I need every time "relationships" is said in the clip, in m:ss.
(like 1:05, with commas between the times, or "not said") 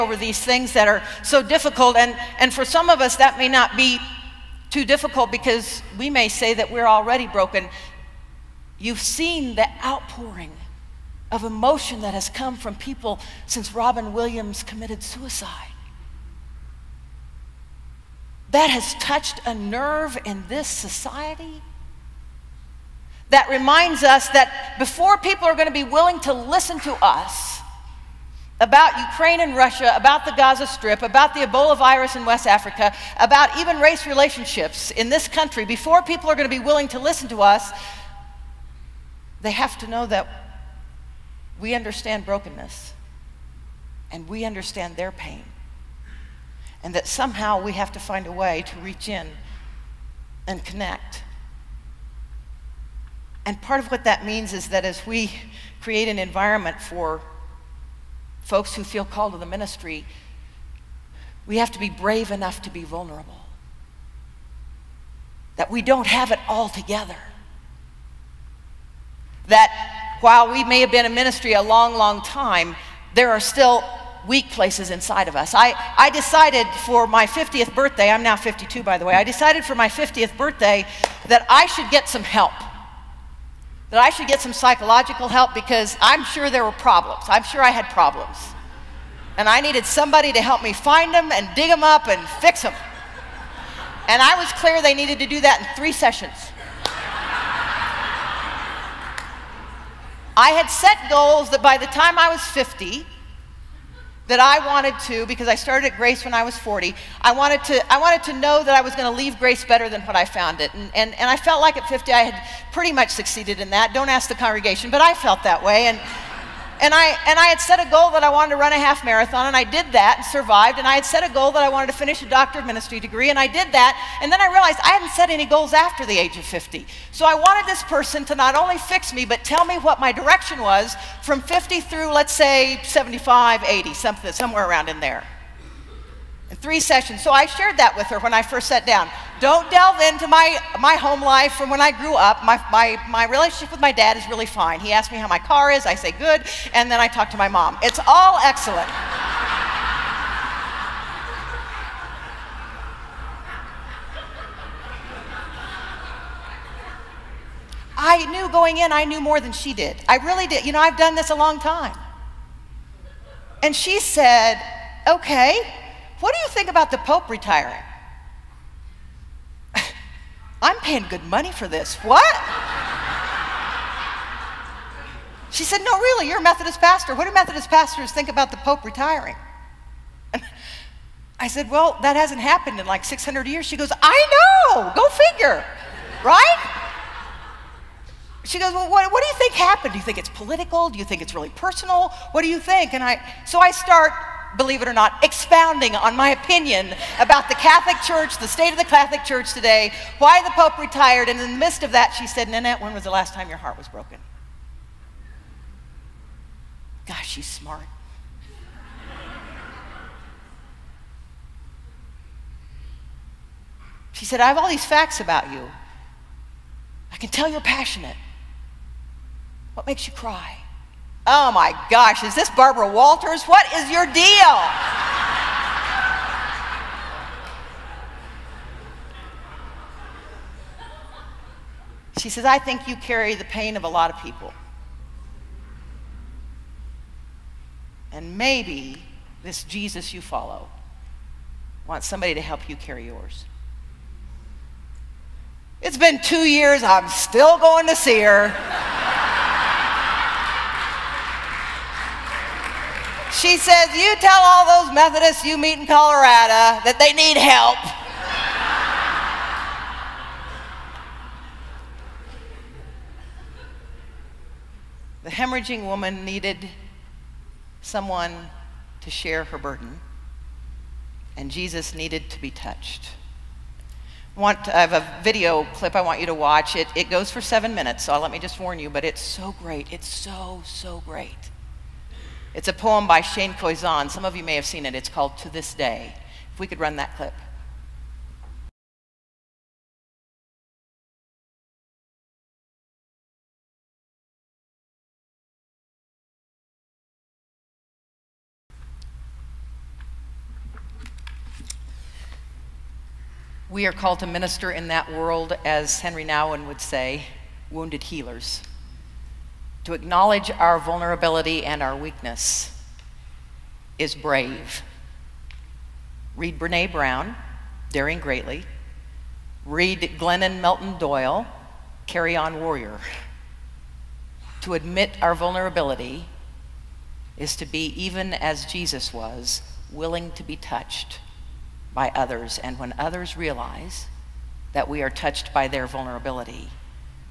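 0:34, 2:23.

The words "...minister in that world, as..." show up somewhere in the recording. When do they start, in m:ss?
5:04.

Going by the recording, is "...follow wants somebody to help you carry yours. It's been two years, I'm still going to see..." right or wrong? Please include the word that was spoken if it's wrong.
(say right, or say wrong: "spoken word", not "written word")
right.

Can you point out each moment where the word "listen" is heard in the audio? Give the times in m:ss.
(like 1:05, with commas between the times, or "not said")
0:26, 0:36.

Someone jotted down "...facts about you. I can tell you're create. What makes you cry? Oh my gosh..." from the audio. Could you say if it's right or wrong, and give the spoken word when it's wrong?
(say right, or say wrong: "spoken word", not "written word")
wrong: "passionate", not "create".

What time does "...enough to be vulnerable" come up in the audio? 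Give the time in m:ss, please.
1:02.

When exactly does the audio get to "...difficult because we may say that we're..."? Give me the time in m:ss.
0:04.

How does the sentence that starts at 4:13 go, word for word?
She says, You tell all those Methodists you meet in Colorado that they need help.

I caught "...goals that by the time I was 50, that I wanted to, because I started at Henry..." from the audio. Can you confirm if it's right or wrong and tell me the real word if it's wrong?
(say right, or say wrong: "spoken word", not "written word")
wrong: "Grace", not "Henry".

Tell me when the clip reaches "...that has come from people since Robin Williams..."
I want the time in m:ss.
0:12.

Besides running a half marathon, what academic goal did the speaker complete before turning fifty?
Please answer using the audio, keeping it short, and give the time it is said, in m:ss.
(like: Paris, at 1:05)
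Doctor of ministry degree, at 2:02.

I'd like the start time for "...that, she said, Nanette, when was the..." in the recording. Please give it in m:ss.
3:21.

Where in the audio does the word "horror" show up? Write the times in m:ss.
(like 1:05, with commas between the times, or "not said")
not said.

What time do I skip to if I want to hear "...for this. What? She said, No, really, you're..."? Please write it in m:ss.
2:51.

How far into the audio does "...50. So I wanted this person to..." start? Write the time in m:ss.
2:06.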